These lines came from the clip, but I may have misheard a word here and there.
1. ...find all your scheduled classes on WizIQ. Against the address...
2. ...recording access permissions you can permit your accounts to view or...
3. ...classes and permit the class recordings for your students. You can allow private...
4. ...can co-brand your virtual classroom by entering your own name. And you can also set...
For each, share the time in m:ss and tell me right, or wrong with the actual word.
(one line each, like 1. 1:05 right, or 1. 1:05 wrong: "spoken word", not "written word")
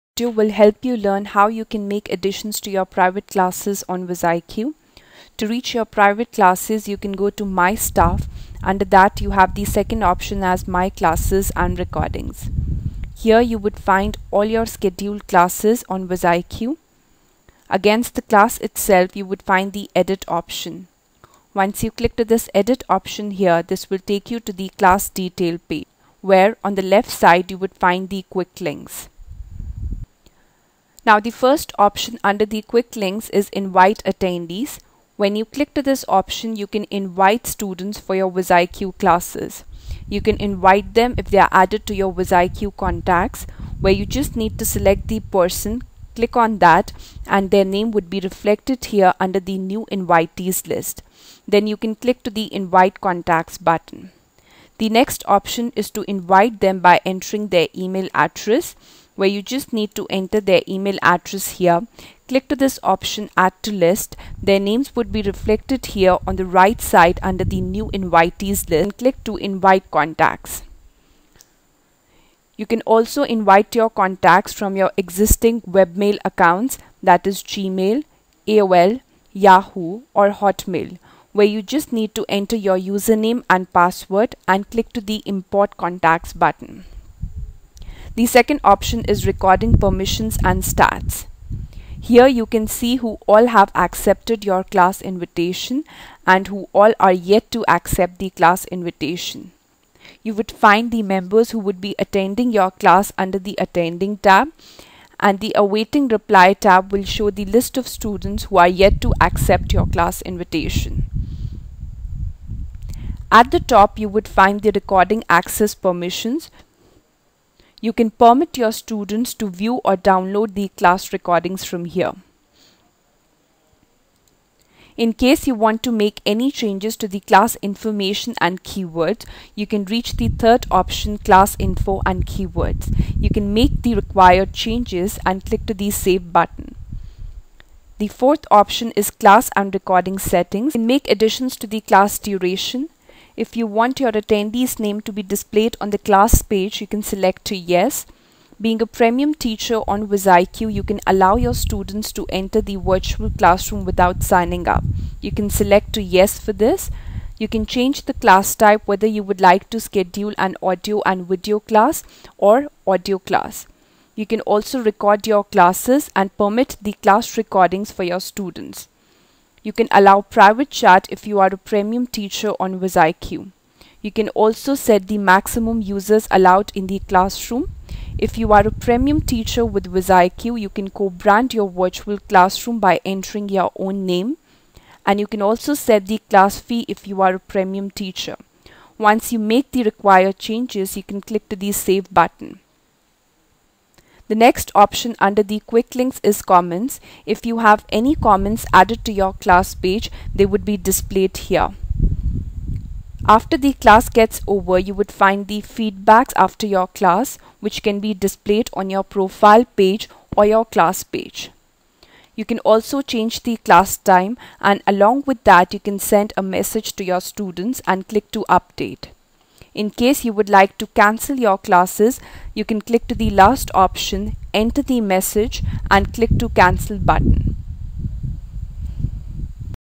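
1. 0:13 wrong: "class", not "address"
2. 1:54 wrong: "students", not "accounts"
3. 2:45 right
4. 3:00 right.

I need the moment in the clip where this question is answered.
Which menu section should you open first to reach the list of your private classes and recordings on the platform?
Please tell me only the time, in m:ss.
0:07.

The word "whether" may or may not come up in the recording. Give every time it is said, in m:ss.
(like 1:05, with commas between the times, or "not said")
2:38.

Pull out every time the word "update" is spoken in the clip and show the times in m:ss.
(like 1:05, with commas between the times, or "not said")
3:38.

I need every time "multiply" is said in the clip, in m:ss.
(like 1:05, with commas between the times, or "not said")
not said.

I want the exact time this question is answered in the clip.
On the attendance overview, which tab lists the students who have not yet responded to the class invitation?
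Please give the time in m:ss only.
1:45.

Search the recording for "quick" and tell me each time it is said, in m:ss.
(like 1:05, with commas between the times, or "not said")
0:28, 0:32, 3:15.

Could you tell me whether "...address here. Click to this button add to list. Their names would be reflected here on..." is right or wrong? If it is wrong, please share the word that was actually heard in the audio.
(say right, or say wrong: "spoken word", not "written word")
wrong: "option", not "button".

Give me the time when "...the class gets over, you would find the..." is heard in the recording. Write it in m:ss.
3:23.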